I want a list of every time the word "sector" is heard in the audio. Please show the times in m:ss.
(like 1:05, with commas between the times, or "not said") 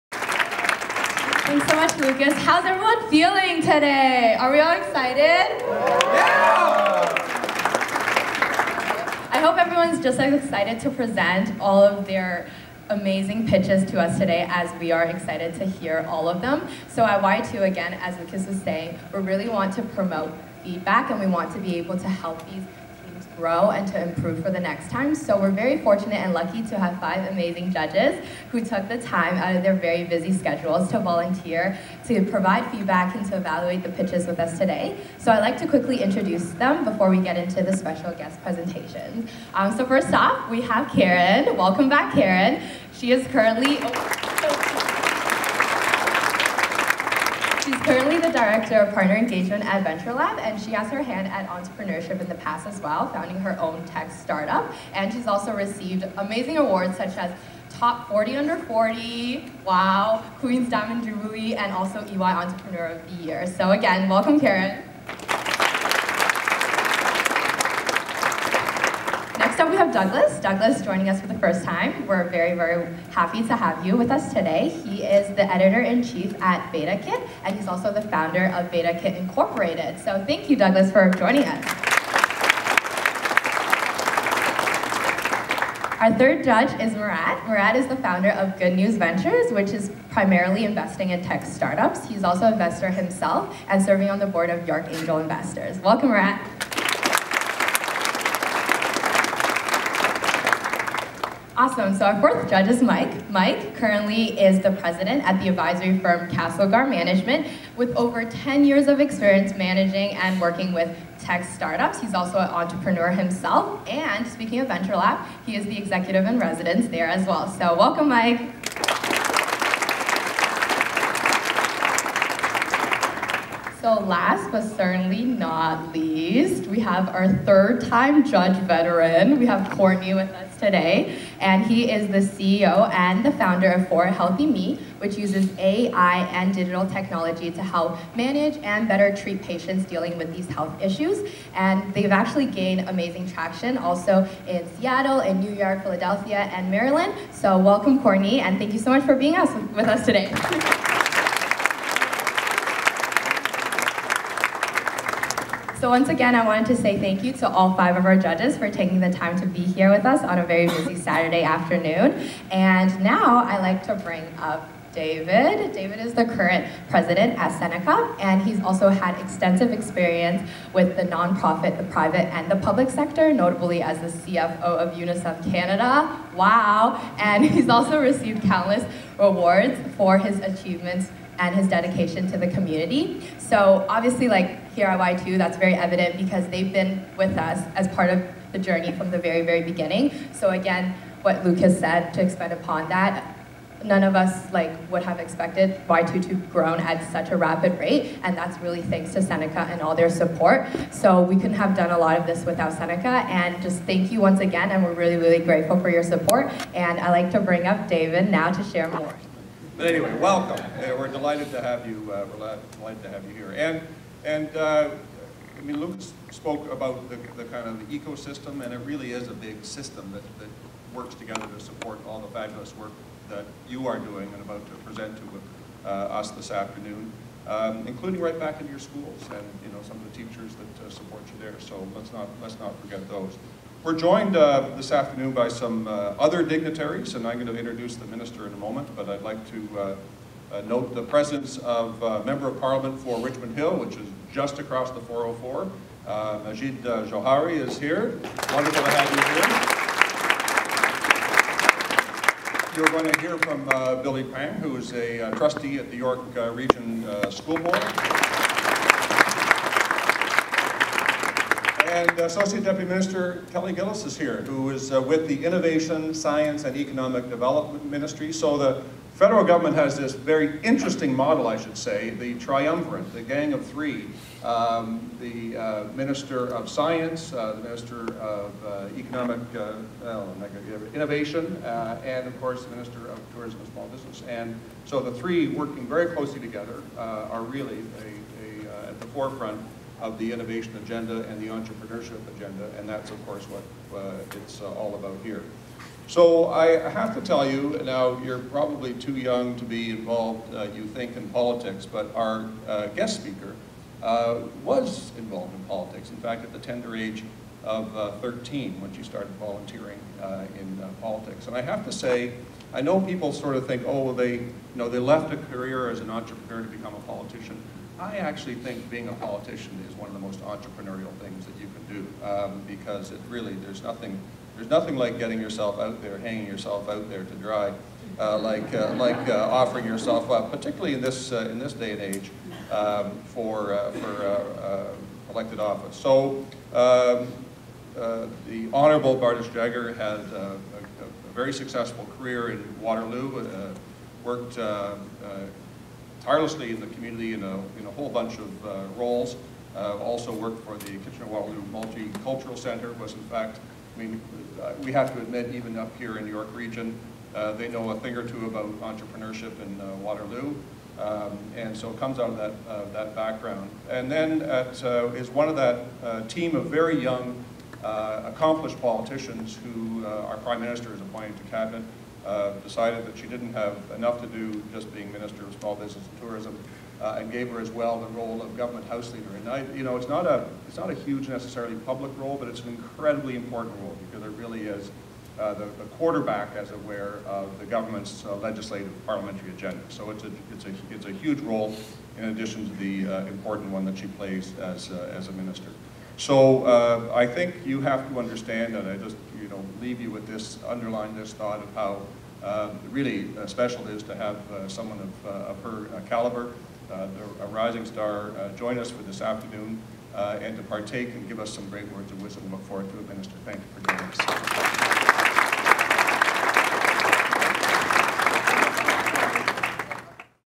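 2:52.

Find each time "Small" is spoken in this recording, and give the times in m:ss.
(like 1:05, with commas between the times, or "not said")
4:43, 6:15.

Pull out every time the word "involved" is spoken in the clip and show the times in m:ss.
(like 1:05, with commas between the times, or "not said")
4:59, 5:05.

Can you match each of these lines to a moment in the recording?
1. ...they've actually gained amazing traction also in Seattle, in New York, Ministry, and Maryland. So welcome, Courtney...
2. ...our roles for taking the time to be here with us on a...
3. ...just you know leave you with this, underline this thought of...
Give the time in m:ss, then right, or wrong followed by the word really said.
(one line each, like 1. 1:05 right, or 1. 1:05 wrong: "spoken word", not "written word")
1. 2:21 wrong: "Philadelphia", not "Ministry"
2. 2:38 wrong: "judges", not "roles"
3. 6:38 right.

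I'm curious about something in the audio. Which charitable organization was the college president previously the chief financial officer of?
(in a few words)
UNICEF Canada.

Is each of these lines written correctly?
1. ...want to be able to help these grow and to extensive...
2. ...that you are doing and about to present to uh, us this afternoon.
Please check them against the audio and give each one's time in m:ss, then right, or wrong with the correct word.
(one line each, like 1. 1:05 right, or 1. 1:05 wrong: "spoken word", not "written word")
1. 0:21 wrong: "improve", not "extensive"
2. 3:43 right.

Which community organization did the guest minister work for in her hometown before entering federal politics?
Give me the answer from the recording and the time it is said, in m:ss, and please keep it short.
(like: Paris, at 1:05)
Kitchener-Waterloo Multicultural Center, at 5:50.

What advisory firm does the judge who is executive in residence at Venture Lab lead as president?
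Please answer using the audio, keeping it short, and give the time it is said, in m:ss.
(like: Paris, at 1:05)
Castlegar Management, at 1:46.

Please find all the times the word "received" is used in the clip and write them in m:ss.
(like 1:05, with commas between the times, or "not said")
0:55, 2:57.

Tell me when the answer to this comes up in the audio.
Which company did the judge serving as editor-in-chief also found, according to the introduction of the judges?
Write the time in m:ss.
1:18.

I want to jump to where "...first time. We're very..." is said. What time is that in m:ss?
1:11.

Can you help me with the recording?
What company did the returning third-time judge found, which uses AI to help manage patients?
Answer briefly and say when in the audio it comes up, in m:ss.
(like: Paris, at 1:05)
For Healthy Me, at 2:13.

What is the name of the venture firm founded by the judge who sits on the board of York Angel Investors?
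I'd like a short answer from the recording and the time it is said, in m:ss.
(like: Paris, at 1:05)
Good News Ventures, at 1:28.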